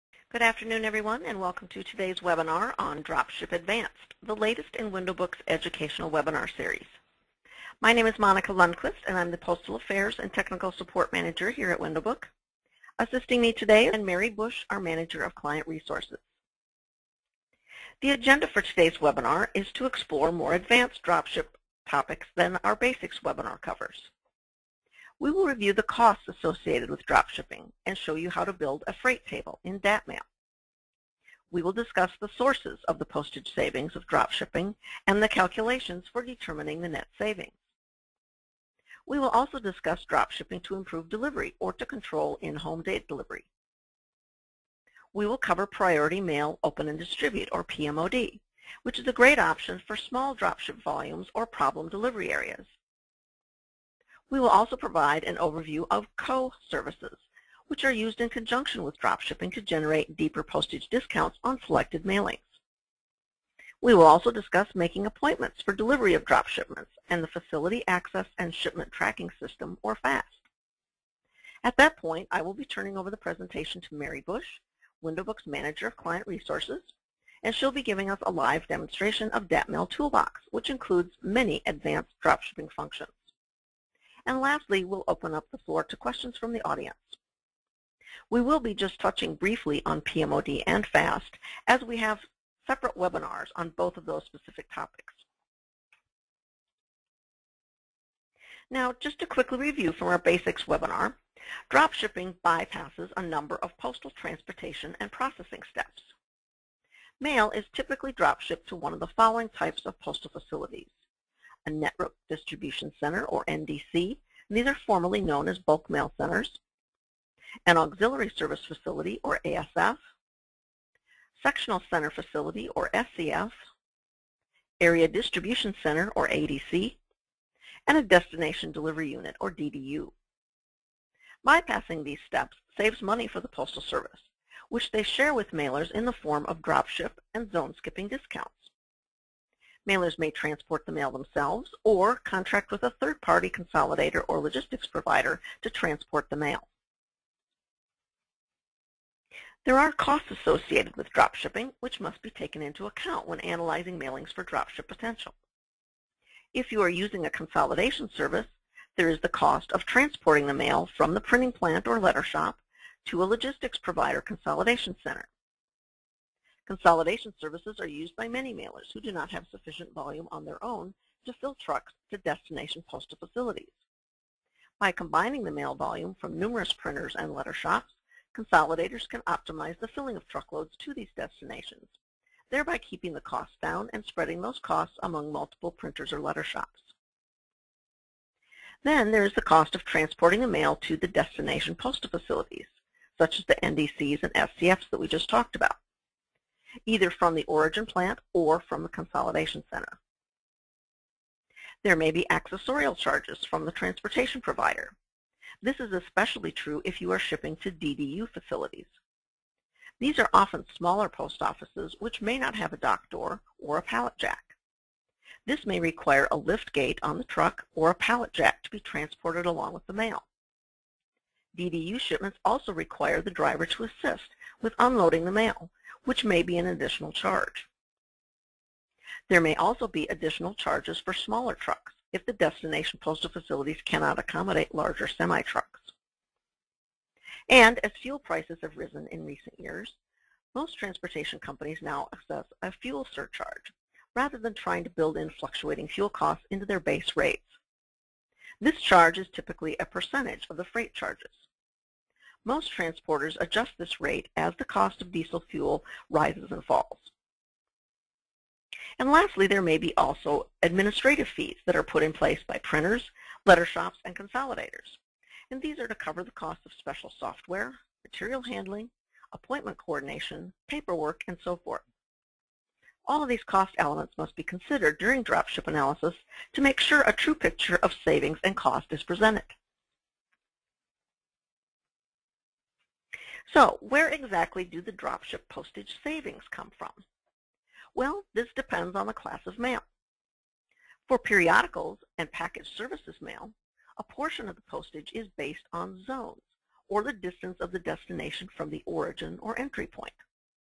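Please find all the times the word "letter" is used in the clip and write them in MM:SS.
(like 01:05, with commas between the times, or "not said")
02:41, 02:57, 03:06, 04:23.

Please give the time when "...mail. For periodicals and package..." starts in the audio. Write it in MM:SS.
04:49.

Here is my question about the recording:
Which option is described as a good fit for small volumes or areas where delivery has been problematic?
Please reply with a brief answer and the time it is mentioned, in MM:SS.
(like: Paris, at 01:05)
Priority Mail Open and Distribute, at 00:45.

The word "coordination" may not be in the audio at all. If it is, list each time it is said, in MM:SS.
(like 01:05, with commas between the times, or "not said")
04:29.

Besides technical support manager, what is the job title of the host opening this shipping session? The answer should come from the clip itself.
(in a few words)
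Postal Affairs.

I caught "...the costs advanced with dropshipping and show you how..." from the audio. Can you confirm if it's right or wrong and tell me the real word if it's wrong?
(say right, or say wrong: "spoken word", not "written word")
wrong: "associated", not "advanced".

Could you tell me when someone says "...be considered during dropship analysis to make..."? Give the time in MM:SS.
04:34.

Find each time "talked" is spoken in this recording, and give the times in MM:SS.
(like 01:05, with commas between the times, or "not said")
03:15.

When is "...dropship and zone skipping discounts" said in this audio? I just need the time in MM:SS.
02:16.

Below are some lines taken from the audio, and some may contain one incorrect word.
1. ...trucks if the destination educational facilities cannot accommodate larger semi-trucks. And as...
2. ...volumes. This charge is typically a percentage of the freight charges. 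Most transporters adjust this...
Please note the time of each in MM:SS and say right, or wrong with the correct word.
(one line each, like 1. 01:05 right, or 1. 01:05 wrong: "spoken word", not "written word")
1. 03:51 wrong: "postal", not "educational"
2. 04:07 wrong: "rates", not "volumes".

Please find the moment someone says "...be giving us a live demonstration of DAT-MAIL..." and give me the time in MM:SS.
01:17.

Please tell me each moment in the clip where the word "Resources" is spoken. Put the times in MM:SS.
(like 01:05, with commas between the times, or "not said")
00:15, 01:16.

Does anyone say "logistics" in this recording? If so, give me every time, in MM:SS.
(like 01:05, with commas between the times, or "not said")
02:24, 02:43.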